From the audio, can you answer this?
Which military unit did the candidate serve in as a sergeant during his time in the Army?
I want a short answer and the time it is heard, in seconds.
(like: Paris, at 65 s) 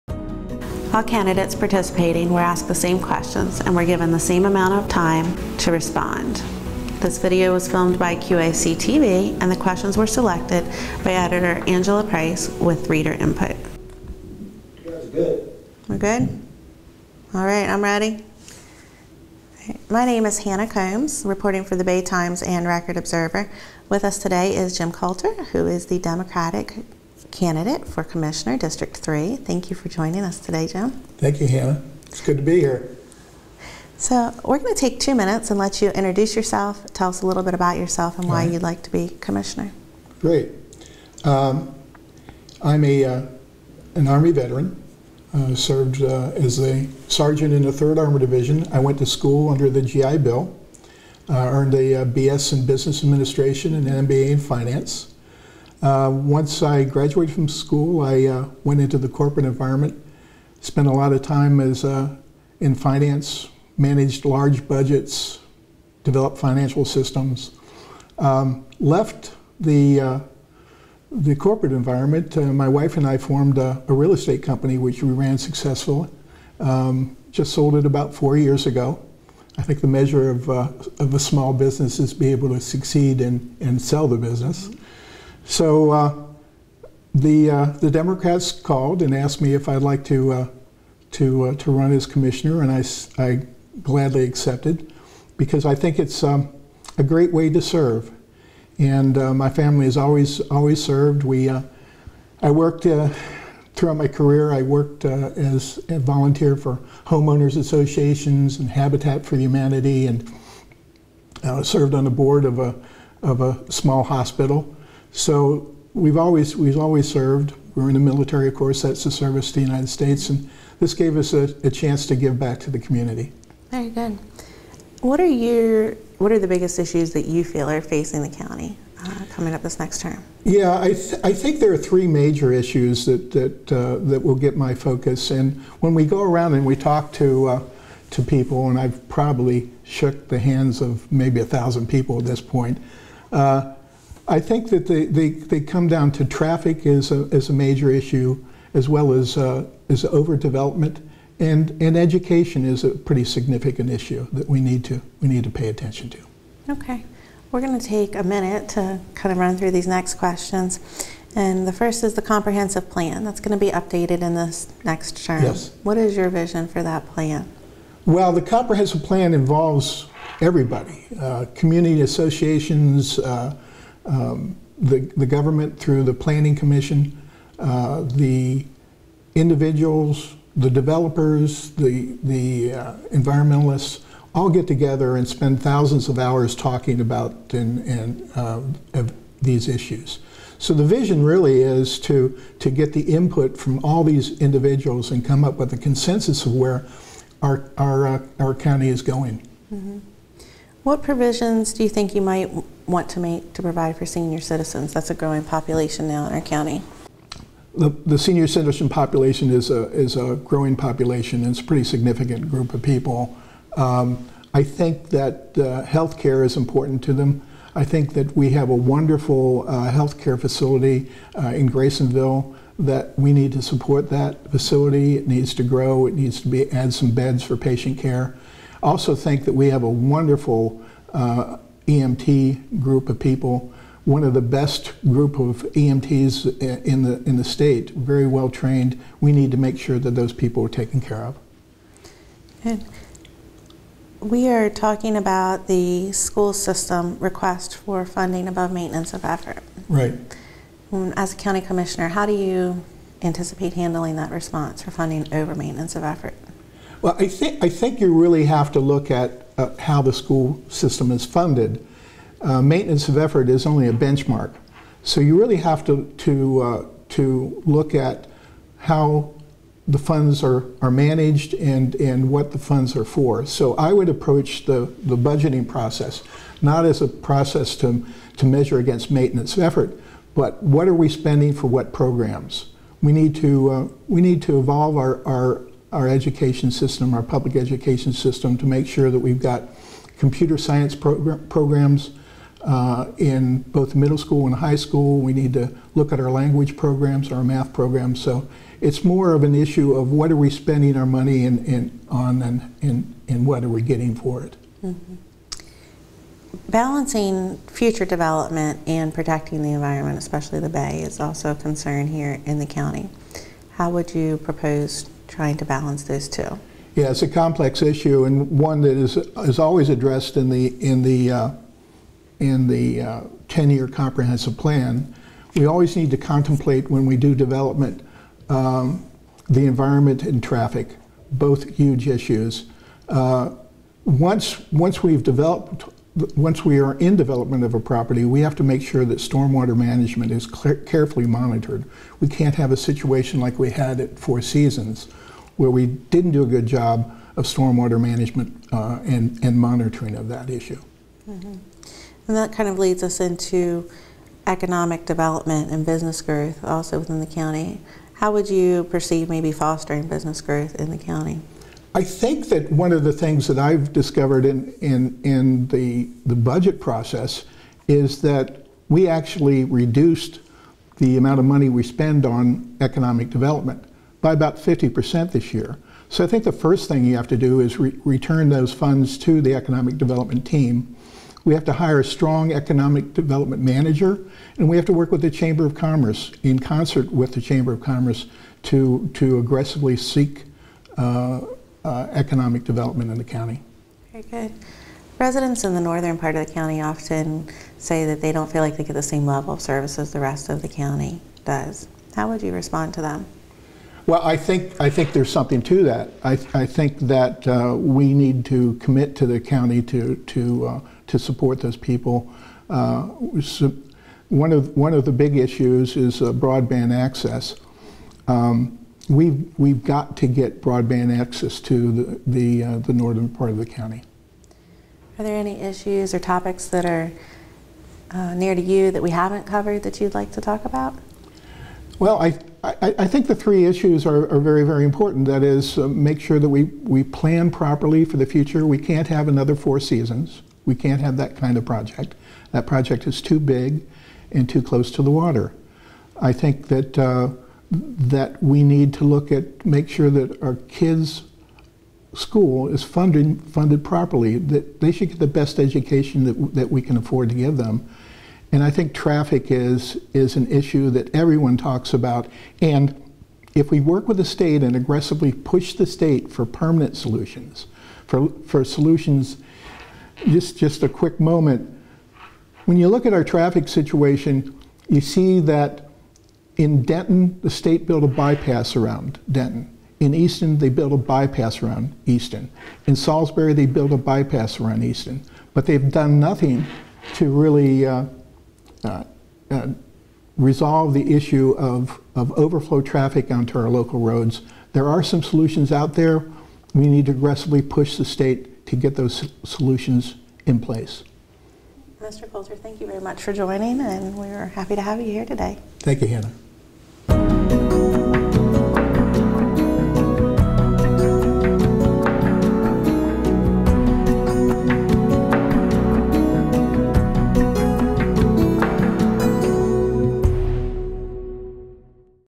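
3rd Armor Division, at 47 s.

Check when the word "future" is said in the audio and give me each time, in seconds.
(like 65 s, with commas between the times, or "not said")
307 s, 438 s.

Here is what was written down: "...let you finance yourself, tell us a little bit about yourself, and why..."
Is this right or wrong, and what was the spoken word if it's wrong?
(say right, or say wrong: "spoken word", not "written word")
wrong: "introduce", not "finance".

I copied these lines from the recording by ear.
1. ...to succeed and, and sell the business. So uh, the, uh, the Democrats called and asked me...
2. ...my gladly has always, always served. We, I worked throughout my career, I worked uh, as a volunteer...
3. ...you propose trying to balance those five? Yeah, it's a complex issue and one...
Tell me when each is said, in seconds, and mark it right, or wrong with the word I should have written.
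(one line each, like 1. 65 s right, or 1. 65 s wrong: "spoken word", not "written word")
1. 82 s right
2. 99 s wrong: "family", not "gladly"
3. 314 s wrong: "two", not "five".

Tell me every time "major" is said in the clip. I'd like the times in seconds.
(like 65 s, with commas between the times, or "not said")
132 s, 147 s.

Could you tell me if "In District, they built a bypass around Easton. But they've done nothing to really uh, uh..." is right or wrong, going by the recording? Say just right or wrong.
wrong.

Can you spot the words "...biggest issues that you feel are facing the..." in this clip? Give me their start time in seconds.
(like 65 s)
126 s.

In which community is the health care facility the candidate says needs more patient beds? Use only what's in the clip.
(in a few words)
Graysonville.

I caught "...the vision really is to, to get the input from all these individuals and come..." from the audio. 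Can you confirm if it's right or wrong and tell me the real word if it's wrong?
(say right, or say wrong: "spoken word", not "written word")
right.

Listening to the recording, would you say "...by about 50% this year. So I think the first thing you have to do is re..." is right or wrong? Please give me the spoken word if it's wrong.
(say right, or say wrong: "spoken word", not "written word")
right.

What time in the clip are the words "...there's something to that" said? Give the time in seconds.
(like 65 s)
405 s.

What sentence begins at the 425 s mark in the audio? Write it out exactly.
Are there any issues or topics that are uh, near to you that we haven't covered that you'd like to talk about?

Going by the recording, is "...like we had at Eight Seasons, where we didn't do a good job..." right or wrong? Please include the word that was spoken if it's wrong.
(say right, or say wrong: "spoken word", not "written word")
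wrong: "Four", not "Eight".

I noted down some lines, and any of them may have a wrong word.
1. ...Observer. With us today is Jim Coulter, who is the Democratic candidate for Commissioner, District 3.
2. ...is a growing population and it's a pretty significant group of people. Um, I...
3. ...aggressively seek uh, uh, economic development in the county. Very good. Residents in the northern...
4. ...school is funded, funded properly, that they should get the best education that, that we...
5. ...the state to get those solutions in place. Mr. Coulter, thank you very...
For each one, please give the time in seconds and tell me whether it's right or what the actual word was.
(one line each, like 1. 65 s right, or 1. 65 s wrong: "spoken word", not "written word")
1. 22 s right
2. 209 s right
3. 389 s right
4. 452 s right
5. 497 s right.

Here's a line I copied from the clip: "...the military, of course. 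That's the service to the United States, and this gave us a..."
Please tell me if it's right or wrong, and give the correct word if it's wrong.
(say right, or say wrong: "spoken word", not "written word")
right.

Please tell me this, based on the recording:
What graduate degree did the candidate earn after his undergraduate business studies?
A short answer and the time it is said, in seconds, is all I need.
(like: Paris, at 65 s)
MBA in Finance, at 54 s.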